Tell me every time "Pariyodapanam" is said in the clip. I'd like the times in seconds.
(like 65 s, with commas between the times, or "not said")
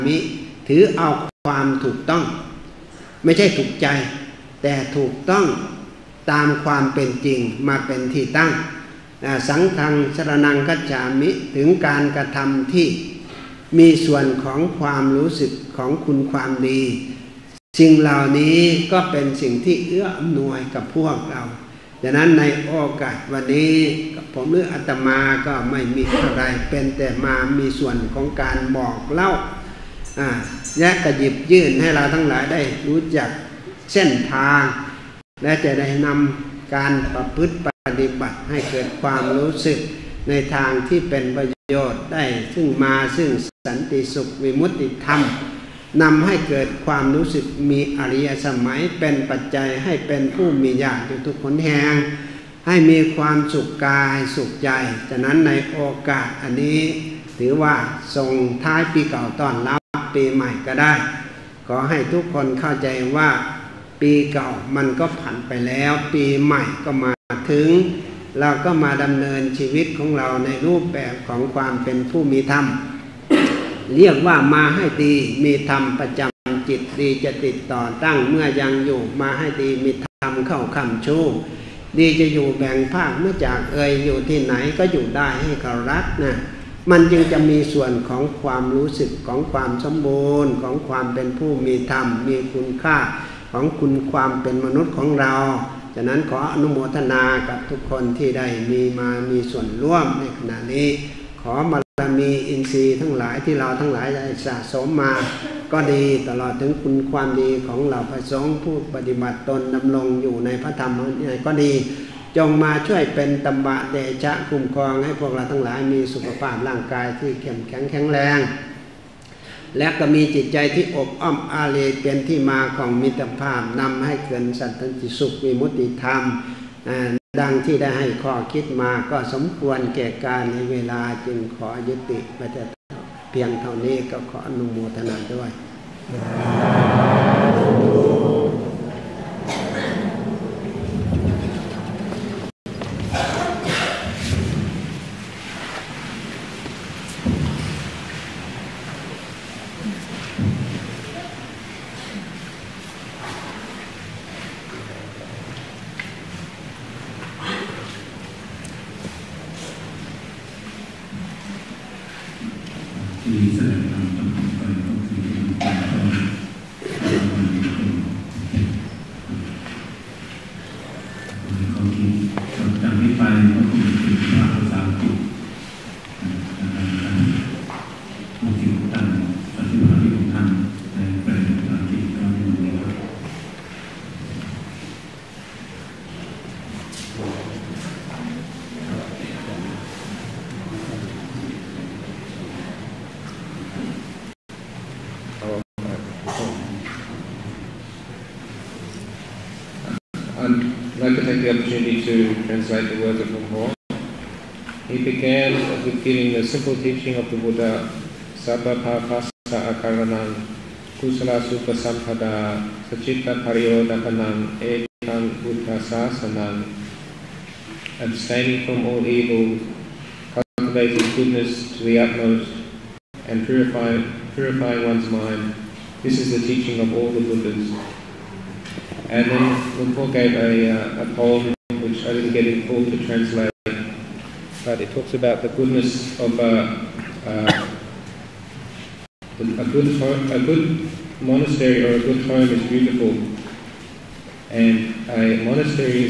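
213 s.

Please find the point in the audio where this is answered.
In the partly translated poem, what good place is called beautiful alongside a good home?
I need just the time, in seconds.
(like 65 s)
240 s.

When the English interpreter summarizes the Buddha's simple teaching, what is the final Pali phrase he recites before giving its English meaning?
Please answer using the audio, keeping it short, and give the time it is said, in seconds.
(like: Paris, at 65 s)
Ekam Buddha Sasanam, at 214 s.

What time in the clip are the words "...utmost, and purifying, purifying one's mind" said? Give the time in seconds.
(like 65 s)
222 s.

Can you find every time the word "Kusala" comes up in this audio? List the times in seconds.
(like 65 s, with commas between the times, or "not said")
210 s.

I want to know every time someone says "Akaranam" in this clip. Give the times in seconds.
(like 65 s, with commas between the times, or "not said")
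209 s.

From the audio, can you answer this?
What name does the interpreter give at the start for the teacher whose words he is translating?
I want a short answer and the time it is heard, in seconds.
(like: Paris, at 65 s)
Mahō, at 203 s.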